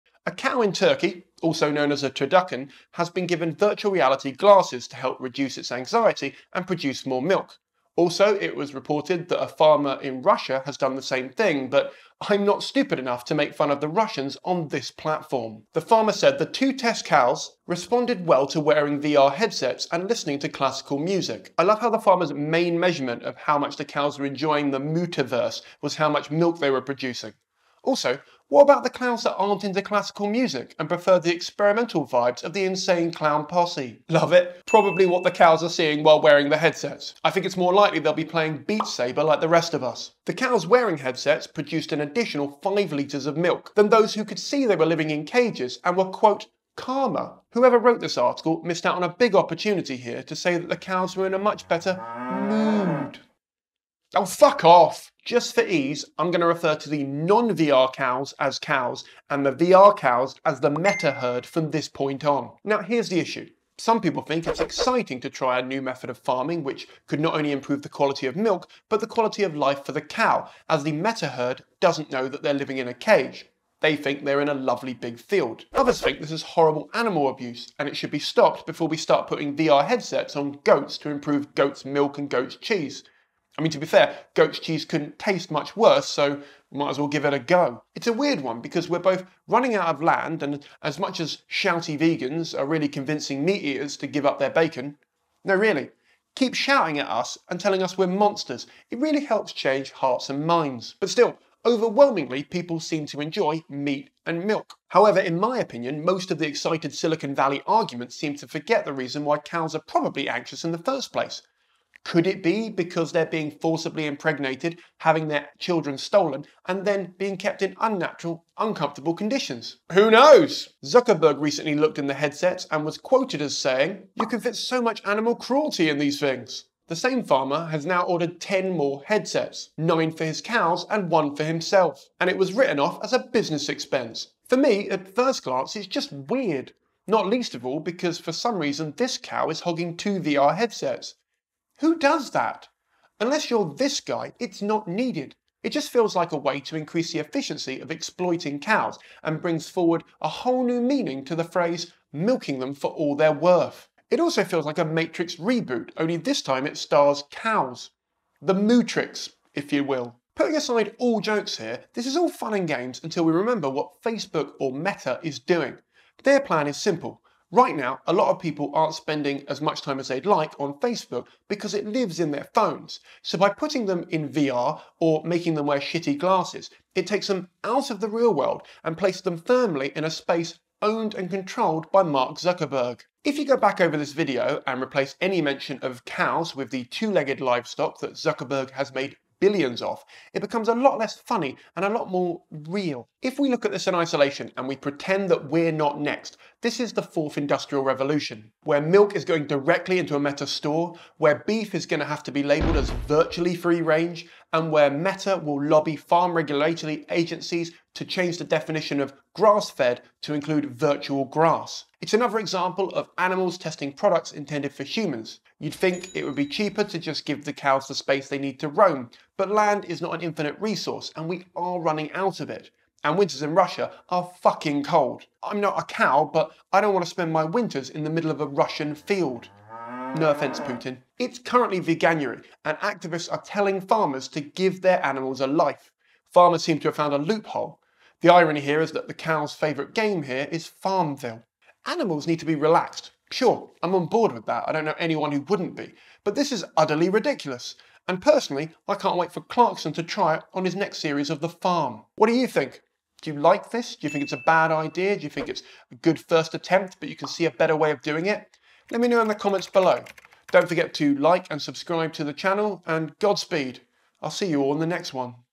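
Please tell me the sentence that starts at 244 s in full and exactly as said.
I don't know anyone who wouldn't be.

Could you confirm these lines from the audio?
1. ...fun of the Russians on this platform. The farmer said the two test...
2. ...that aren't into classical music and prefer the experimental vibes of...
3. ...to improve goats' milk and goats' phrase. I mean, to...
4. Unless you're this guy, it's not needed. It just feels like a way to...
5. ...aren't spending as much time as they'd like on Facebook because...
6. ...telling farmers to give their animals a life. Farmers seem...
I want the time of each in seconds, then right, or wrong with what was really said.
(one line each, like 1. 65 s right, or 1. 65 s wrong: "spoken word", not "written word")
1. 13 s right
2. 29 s right
3. 80 s wrong: "cheese", not "phrase"
4. 143 s right
5. 168 s right
6. 233 s right.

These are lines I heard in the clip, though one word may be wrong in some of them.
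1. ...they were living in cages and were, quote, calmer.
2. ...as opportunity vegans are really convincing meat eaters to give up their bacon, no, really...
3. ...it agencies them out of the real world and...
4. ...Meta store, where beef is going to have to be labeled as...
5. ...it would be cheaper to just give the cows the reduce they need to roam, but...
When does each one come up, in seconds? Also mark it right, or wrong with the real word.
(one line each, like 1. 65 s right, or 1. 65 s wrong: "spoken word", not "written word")
1. 44 s right
2. 91 s wrong: "shouty", not "opportunity"
3. 176 s wrong: "takes", not "agencies"
4. 200 s right
5. 216 s wrong: "space", not "reduce".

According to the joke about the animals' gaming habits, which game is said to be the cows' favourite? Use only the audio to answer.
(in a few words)
Farmville.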